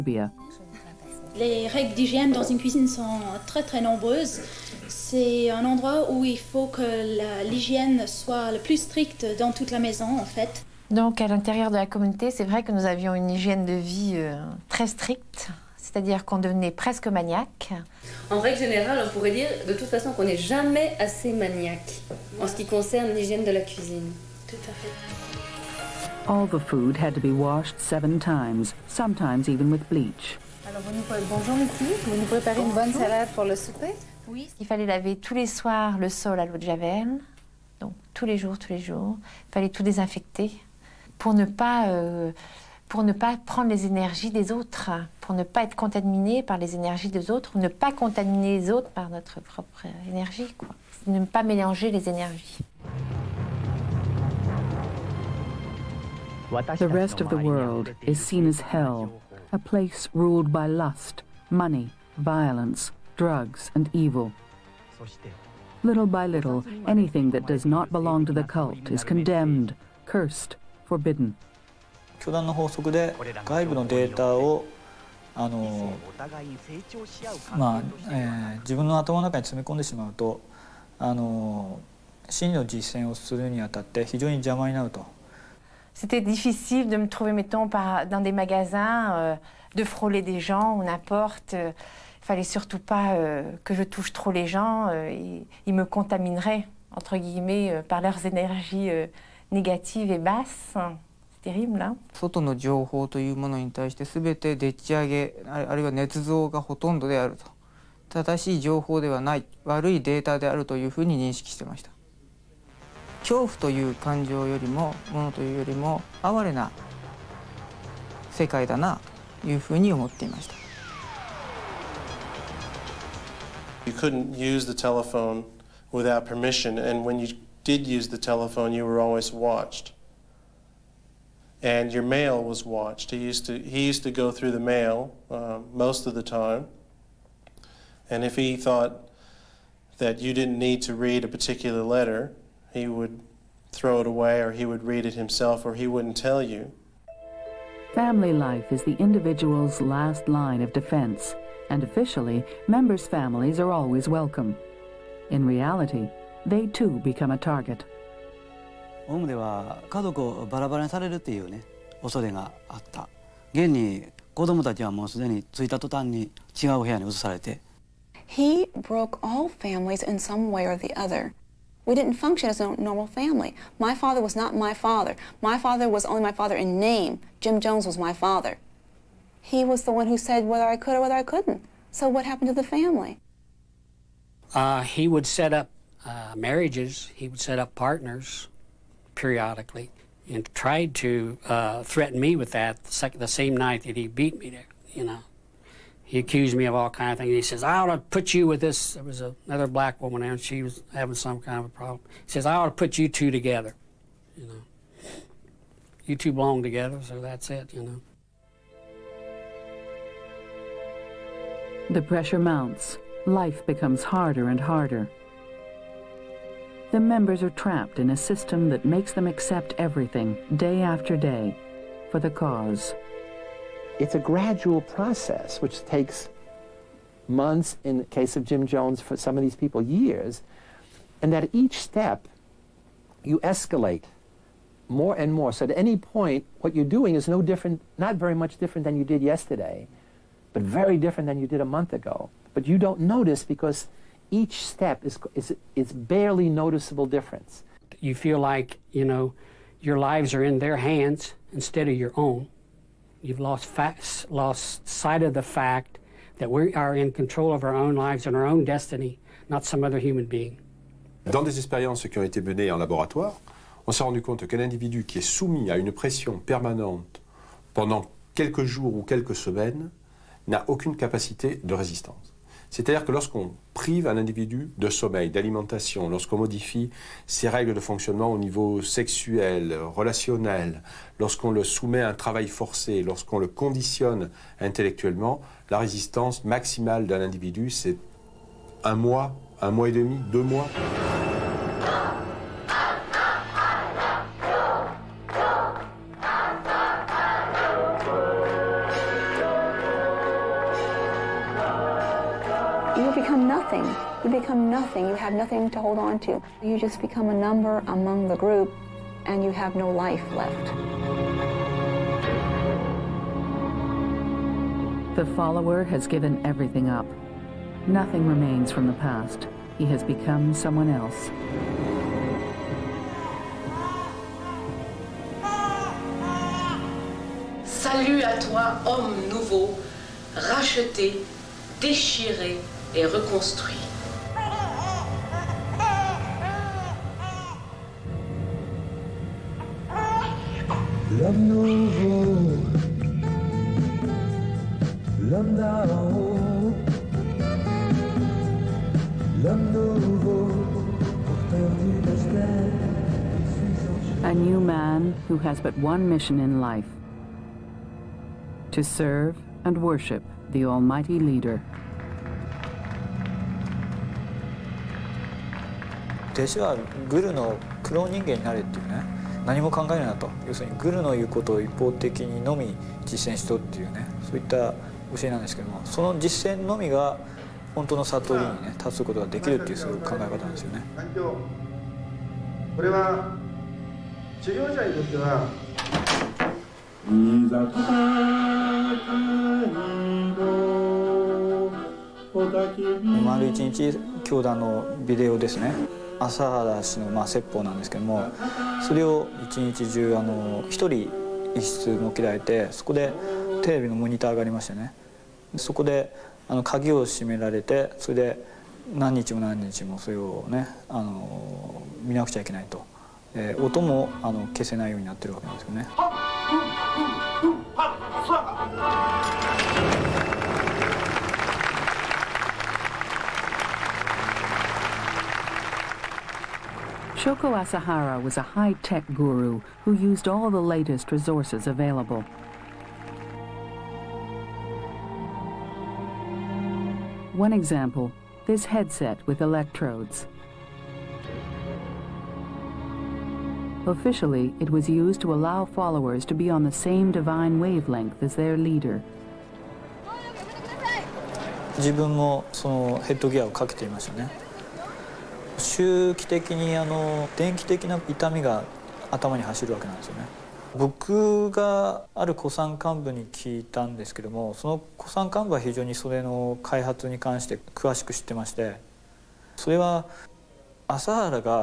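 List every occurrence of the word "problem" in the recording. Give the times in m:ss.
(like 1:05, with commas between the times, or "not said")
3:21.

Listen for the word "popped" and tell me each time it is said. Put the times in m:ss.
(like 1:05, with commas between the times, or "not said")
not said.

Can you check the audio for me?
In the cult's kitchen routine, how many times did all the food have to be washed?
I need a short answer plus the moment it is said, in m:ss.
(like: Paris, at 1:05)
7, at 0:27.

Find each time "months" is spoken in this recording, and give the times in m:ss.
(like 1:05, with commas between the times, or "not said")
3:47, 4:01.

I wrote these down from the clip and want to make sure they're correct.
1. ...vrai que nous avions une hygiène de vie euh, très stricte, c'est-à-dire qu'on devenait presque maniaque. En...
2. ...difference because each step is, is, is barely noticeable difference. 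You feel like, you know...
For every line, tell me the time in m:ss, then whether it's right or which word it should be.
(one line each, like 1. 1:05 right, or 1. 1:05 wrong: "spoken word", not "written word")
1. 0:12 right
2. 4:02 wrong: "notice", not "difference".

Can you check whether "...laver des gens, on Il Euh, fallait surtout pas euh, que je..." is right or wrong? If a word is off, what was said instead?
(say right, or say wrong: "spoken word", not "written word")
wrong: "frôler", not "laver".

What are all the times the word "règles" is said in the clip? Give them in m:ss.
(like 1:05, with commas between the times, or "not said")
0:01, 0:18, 4:37.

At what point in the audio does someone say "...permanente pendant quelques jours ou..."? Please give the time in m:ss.
4:26.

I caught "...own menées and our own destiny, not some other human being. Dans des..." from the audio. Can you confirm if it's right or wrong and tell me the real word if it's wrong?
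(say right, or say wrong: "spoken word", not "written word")
wrong: "lives", not "menées".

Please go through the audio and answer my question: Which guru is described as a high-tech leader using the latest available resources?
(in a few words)
Shoko Asahara.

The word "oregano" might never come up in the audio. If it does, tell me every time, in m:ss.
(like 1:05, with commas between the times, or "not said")
not said.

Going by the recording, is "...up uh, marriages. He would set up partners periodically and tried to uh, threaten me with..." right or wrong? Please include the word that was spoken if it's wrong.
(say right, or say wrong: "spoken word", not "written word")
right.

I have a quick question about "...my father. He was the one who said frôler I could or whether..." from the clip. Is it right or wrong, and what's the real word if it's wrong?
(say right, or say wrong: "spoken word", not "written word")
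wrong: "whether", not "frôler".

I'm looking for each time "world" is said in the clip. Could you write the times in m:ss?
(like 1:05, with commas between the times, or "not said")
0:57.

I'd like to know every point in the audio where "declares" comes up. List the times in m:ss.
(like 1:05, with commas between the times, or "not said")
not said.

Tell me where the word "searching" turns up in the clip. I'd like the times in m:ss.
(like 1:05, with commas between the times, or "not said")
not said.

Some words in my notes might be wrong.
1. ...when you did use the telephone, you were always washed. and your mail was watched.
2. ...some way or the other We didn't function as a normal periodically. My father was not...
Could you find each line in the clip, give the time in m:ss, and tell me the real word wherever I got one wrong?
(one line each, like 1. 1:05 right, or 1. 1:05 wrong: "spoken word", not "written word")
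1. 2:07 wrong: "watched", not "washed"
2. 2:50 wrong: "family", not "periodically".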